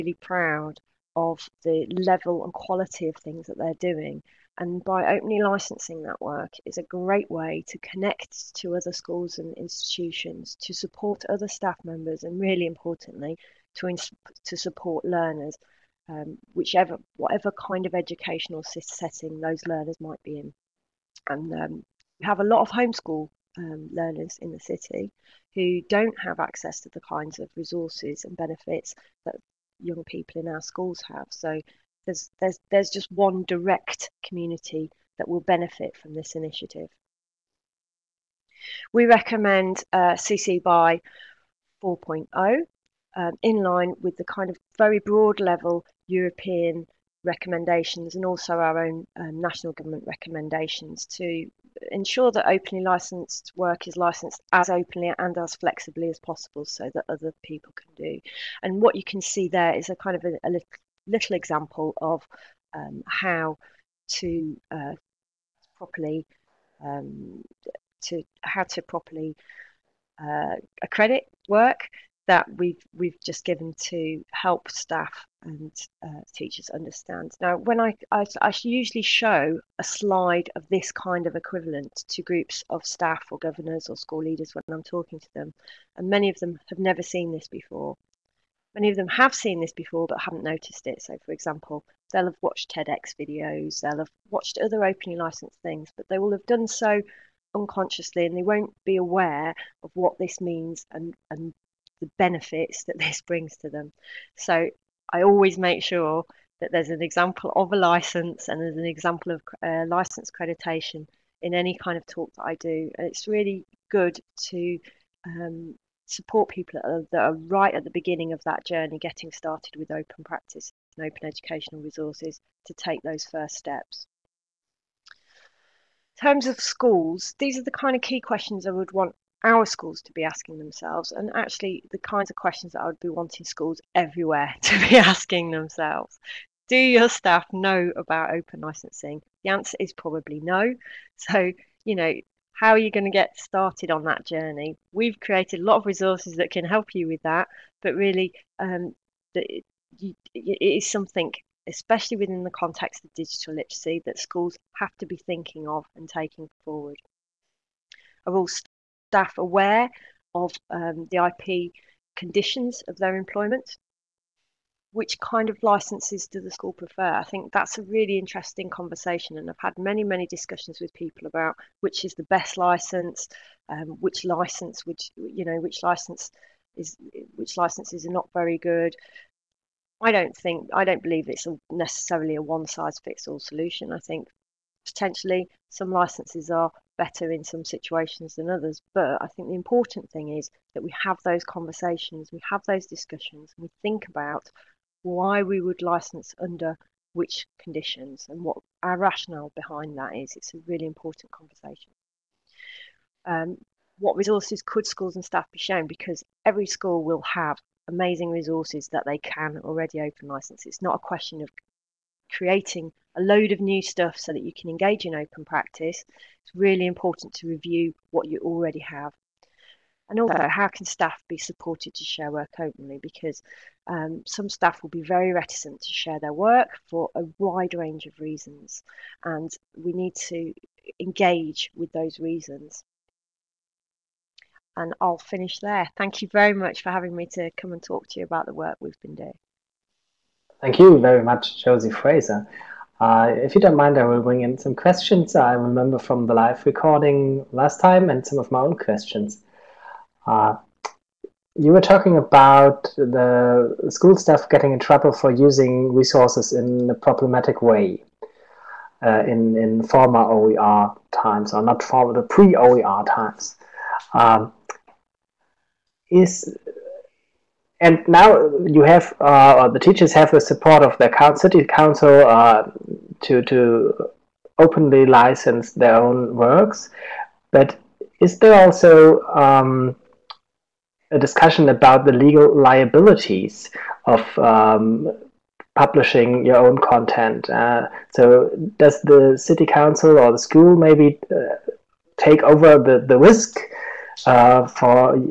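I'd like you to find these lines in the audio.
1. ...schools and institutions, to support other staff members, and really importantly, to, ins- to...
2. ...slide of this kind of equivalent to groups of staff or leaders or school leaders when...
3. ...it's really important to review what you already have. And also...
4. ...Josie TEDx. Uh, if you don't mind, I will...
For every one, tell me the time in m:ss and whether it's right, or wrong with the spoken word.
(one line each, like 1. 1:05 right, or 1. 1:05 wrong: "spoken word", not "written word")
1. 0:08 right
2. 1:19 wrong: "governors", not "leaders"
3. 3:36 right
4. 4:01 wrong: "Fraser", not "TEDx".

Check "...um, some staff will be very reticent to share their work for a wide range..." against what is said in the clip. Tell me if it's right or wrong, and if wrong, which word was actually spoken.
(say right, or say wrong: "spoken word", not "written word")
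right.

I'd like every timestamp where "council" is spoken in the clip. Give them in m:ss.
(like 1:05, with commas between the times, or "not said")
4:31, 4:49.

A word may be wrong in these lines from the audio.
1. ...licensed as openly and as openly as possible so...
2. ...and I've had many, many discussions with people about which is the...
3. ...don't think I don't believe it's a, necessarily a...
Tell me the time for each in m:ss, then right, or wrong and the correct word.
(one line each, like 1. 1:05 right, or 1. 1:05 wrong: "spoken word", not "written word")
1. 0:53 wrong: "flexibly", not "openly"
2. 2:49 right
3. 3:00 right.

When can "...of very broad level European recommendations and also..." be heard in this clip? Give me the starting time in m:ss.
0:44.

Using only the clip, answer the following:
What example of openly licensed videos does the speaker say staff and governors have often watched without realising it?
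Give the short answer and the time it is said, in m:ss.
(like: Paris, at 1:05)
TEDx videos, at 1:32.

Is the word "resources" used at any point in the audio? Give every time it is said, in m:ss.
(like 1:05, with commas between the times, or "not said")
0:27, 2:01, 2:25, 3:24, 3:28, 4:15.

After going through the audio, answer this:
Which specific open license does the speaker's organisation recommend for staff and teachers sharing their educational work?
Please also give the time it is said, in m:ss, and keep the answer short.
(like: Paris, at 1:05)
CC BY 4.0, at 0:40.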